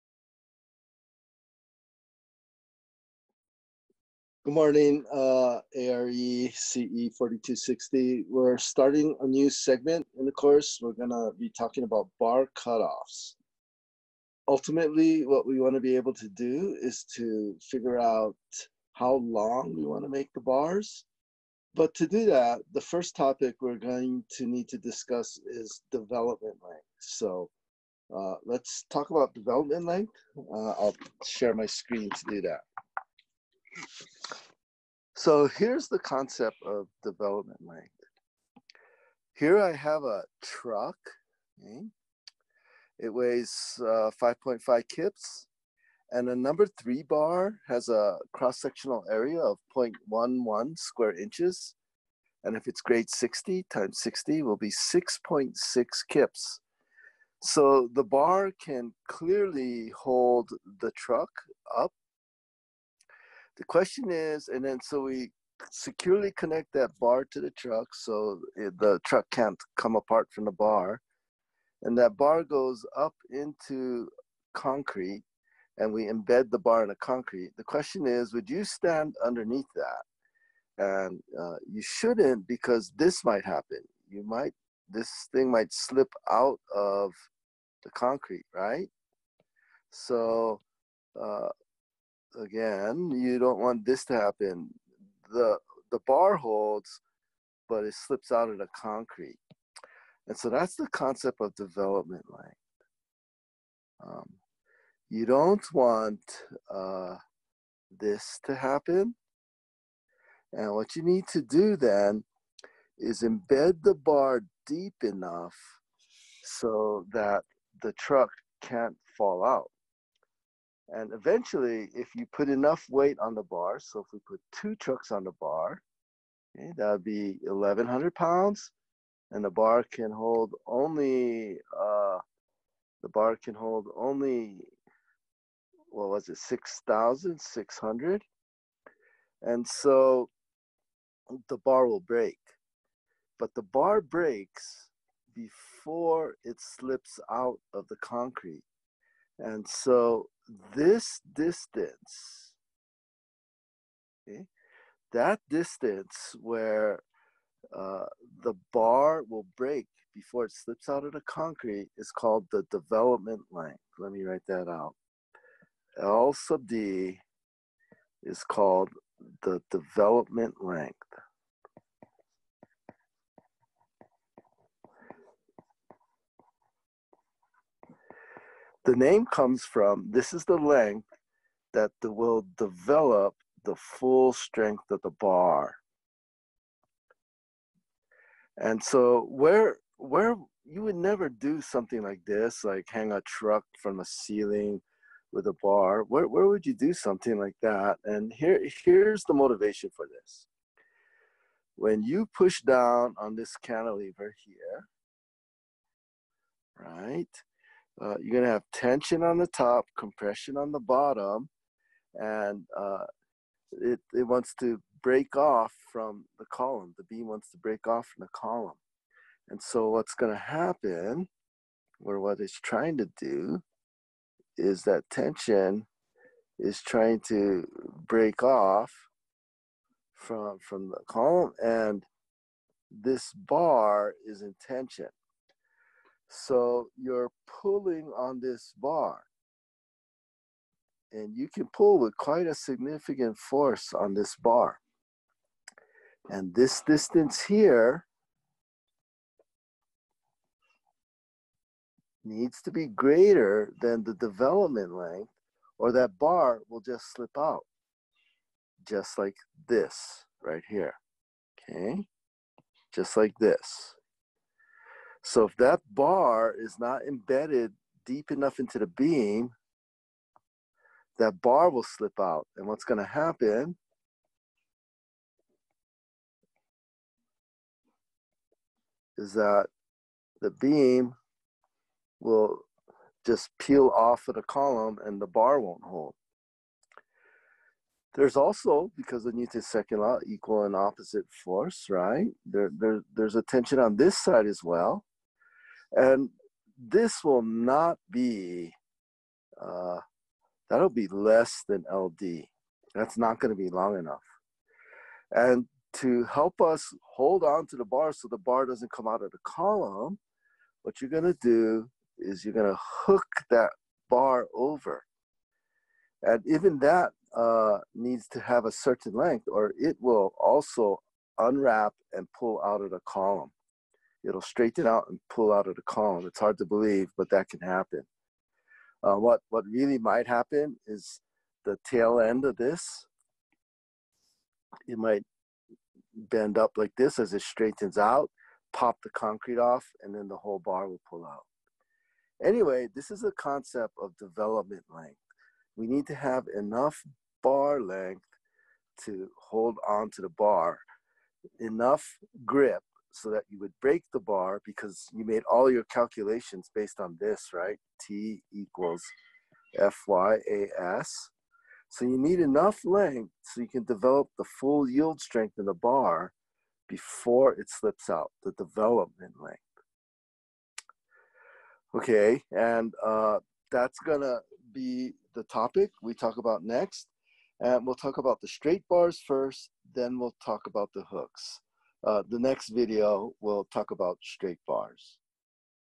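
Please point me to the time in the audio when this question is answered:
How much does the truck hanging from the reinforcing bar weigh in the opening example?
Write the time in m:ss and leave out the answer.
0:44.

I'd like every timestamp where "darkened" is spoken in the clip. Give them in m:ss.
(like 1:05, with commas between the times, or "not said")
not said.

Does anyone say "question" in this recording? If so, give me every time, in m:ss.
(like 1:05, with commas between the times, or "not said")
1:03, 1:17.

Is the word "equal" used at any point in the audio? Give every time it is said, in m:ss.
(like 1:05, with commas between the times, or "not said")
4:50, 5:58.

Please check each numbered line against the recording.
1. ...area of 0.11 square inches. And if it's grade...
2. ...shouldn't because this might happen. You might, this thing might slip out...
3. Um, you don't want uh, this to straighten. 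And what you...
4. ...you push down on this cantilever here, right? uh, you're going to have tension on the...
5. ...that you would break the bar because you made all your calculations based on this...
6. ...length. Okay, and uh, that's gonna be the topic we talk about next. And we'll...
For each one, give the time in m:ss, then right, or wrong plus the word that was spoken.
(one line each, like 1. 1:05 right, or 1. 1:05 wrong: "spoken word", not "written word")
1. 0:49 right
2. 1:21 right
3. 1:44 wrong: "happen", not "straighten"
4. 3:22 right
5. 5:53 right
6. 6:09 right.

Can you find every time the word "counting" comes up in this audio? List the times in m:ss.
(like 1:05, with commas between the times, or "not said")
not said.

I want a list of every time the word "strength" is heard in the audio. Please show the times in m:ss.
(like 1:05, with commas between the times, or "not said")
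3:04, 6:05.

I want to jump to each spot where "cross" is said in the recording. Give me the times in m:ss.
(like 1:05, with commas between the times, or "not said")
0:48.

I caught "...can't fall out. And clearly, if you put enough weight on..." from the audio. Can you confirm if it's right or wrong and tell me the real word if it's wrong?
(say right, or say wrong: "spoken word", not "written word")
wrong: "eventually", not "clearly".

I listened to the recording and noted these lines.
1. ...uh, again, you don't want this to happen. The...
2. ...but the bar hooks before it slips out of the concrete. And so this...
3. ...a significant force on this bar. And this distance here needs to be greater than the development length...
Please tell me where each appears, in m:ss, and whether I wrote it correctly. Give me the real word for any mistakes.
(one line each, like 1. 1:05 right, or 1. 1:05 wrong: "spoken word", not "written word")
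1. 1:31 right
2. 2:23 wrong: "breaks", not "hooks"
3. 4:02 right.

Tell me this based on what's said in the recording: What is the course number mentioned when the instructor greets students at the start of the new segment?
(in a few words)
4260.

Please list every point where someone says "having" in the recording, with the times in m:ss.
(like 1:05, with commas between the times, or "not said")
not said.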